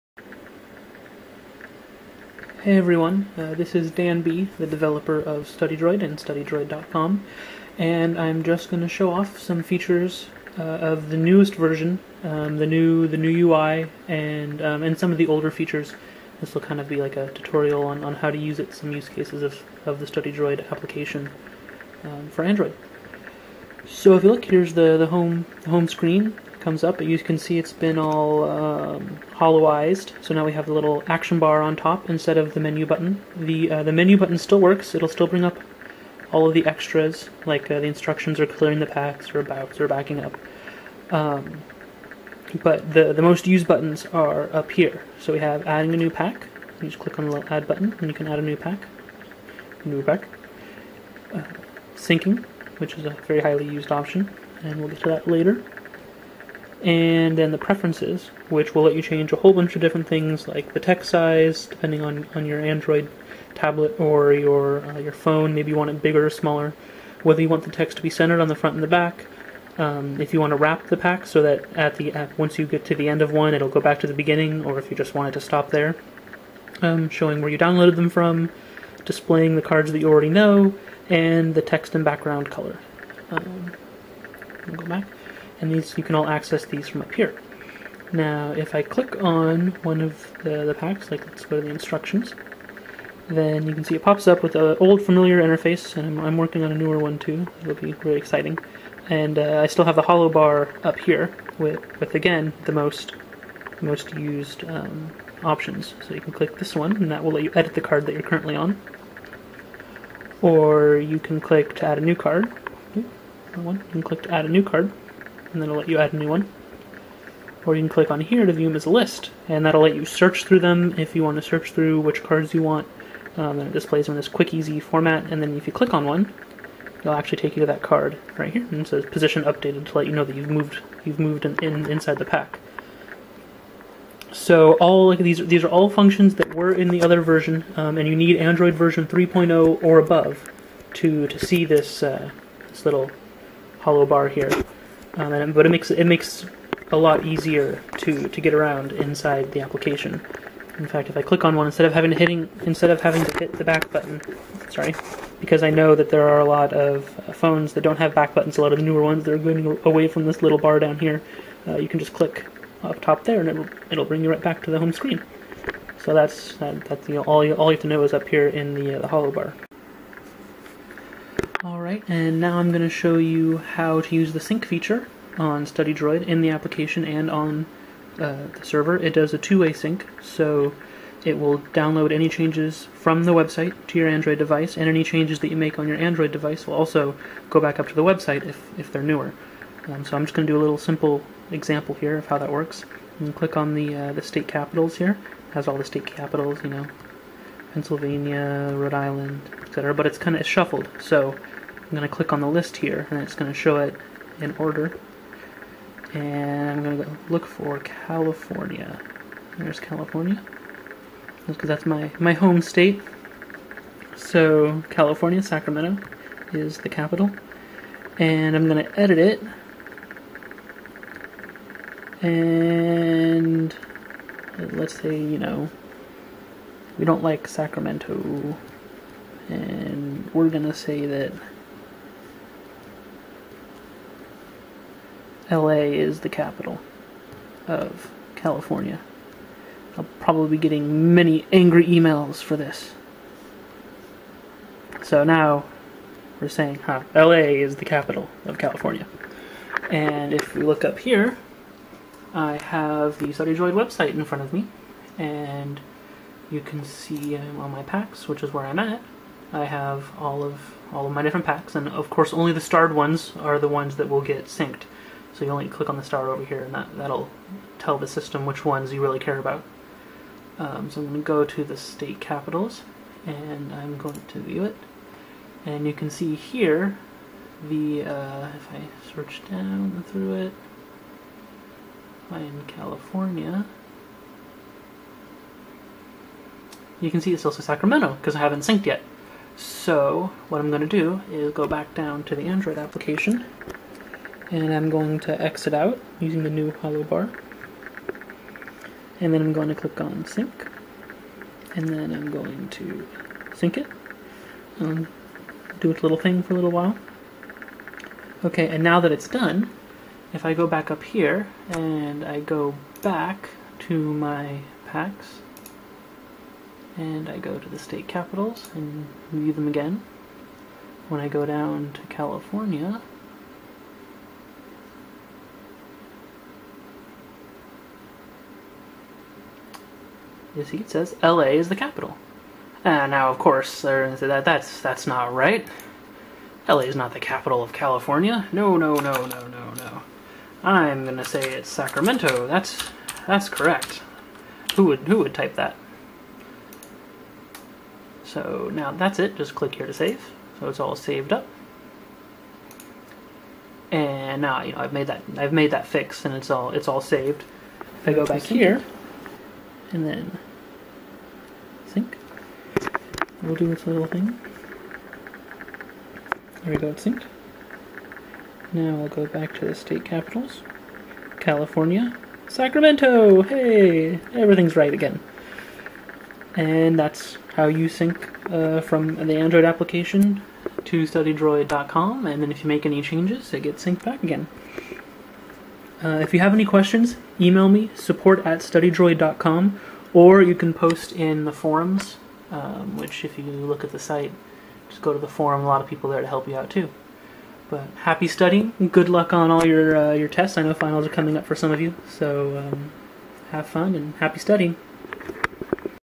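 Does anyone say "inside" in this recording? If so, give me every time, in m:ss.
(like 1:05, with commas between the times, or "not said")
2:11, 2:28.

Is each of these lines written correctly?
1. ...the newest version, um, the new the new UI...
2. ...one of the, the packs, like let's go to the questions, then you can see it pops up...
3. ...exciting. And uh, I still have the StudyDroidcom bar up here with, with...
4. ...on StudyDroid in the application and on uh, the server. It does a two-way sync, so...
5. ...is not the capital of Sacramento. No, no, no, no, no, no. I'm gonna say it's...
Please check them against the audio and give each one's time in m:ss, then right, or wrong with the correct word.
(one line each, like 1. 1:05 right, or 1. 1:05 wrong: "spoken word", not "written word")
1. 0:11 right
2. 1:29 wrong: "instructions", not "questions"
3. 1:38 wrong: "Holo", not "StudyDroidcom"
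4. 2:55 right
5. 5:36 wrong: "California", not "Sacramento".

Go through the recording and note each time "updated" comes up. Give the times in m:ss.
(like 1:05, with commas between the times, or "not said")
2:09.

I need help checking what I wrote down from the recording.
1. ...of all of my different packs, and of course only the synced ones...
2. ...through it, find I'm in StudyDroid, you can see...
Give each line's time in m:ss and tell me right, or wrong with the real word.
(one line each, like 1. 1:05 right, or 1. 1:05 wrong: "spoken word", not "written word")
1. 4:20 wrong: "starred", not "synced"
2. 4:40 wrong: "California", not "StudyDroid".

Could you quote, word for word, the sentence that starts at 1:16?
Um, showing where you downloaded them from, displaying the cards that you already know, and the text and background color.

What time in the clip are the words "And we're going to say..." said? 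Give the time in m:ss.
3:49.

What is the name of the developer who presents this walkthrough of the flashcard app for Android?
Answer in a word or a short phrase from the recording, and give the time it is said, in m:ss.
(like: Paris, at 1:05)
Dan B, at 0:03.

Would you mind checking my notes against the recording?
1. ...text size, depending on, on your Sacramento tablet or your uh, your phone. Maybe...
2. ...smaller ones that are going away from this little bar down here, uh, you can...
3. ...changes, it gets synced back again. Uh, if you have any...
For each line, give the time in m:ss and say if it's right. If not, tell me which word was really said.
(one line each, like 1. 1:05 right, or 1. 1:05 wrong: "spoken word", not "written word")
1. 1:00 wrong: "Android", not "Sacramento"
2. 2:38 wrong: "newer", not "smaller"
3. 6:23 right.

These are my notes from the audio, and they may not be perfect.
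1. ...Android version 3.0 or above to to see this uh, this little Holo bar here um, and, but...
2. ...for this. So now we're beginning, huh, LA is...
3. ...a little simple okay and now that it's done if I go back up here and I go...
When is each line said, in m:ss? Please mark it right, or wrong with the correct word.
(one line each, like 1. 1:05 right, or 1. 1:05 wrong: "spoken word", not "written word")
1. 2:18 right
2. 4:02 wrong: "saying", not "beginning"
3. 5:06 wrong: "while", not "simple".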